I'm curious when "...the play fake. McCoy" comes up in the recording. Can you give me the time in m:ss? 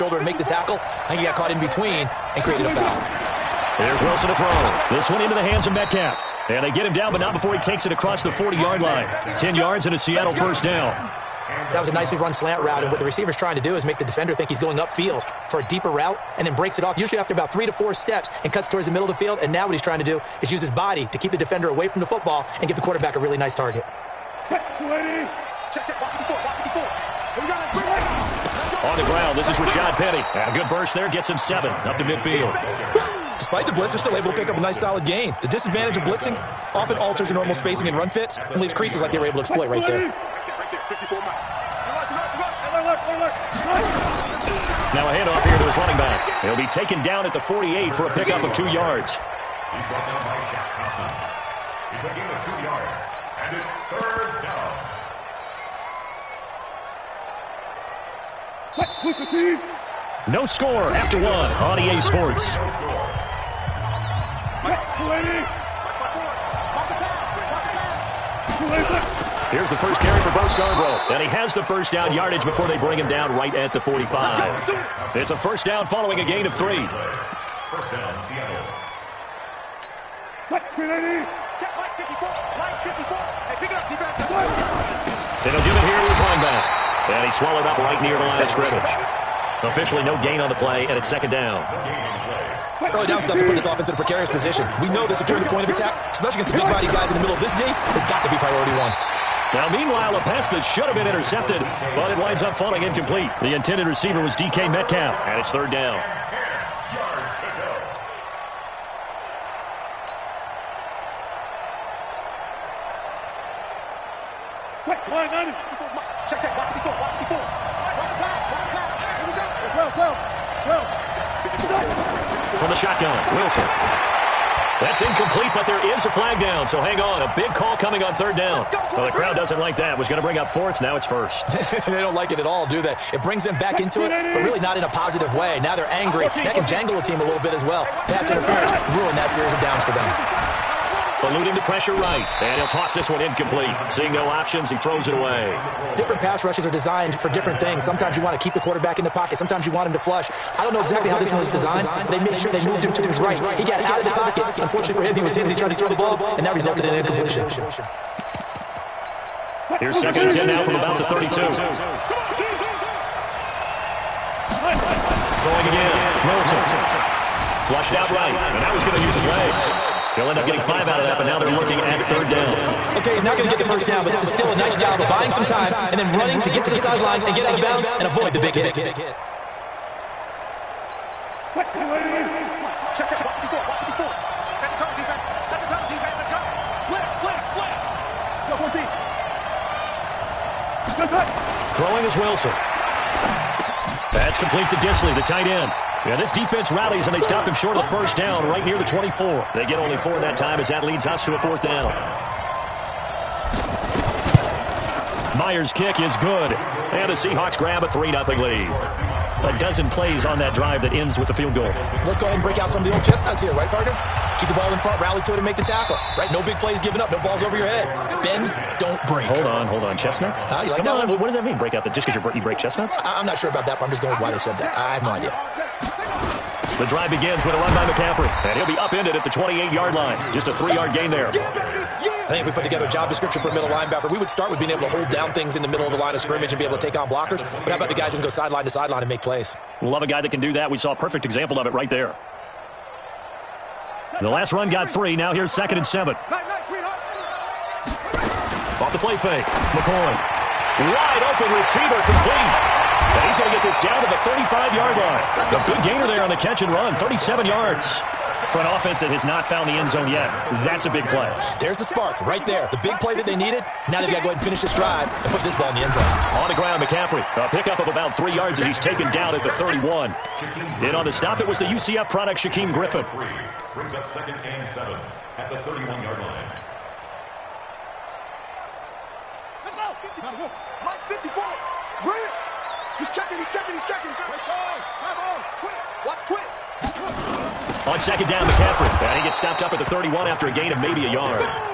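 4:08.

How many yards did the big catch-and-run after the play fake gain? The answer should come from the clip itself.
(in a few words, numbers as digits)
37.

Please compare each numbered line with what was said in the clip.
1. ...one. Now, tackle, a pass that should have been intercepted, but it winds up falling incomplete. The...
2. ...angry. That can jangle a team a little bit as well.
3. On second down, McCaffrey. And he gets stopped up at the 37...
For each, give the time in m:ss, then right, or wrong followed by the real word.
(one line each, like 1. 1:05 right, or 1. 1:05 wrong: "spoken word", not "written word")
1. 1:38 wrong: "meanwhile", not "tackle"
2. 2:15 right
3. 4:47 wrong: "31", not "37".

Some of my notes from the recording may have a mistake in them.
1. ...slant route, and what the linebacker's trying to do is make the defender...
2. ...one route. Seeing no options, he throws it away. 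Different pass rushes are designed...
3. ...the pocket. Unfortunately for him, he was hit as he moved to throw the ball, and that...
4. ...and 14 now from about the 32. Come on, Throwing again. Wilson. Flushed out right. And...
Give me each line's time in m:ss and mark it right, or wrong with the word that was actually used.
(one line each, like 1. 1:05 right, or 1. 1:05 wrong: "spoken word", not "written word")
1. 0:12 wrong: "receiver", not "linebacker"
2. 2:23 wrong: "incomplete", not "route"
3. 2:34 wrong: "tried", not "moved"
4. 2:40 wrong: "10", not "14".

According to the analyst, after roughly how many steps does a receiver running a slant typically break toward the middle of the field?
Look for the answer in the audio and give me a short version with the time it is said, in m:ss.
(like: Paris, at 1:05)
3 to 4, at 0:17.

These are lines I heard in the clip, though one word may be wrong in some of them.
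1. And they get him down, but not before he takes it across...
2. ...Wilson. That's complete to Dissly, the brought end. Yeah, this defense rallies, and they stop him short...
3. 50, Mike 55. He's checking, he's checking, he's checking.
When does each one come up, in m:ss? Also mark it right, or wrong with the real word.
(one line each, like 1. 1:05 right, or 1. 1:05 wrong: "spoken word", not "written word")
1. 0:06 right
2. 3:12 wrong: "tight", not "brought"
3. 4:40 wrong: "54", not "55".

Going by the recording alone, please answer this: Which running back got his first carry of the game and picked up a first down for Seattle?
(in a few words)
Bo Scarborough.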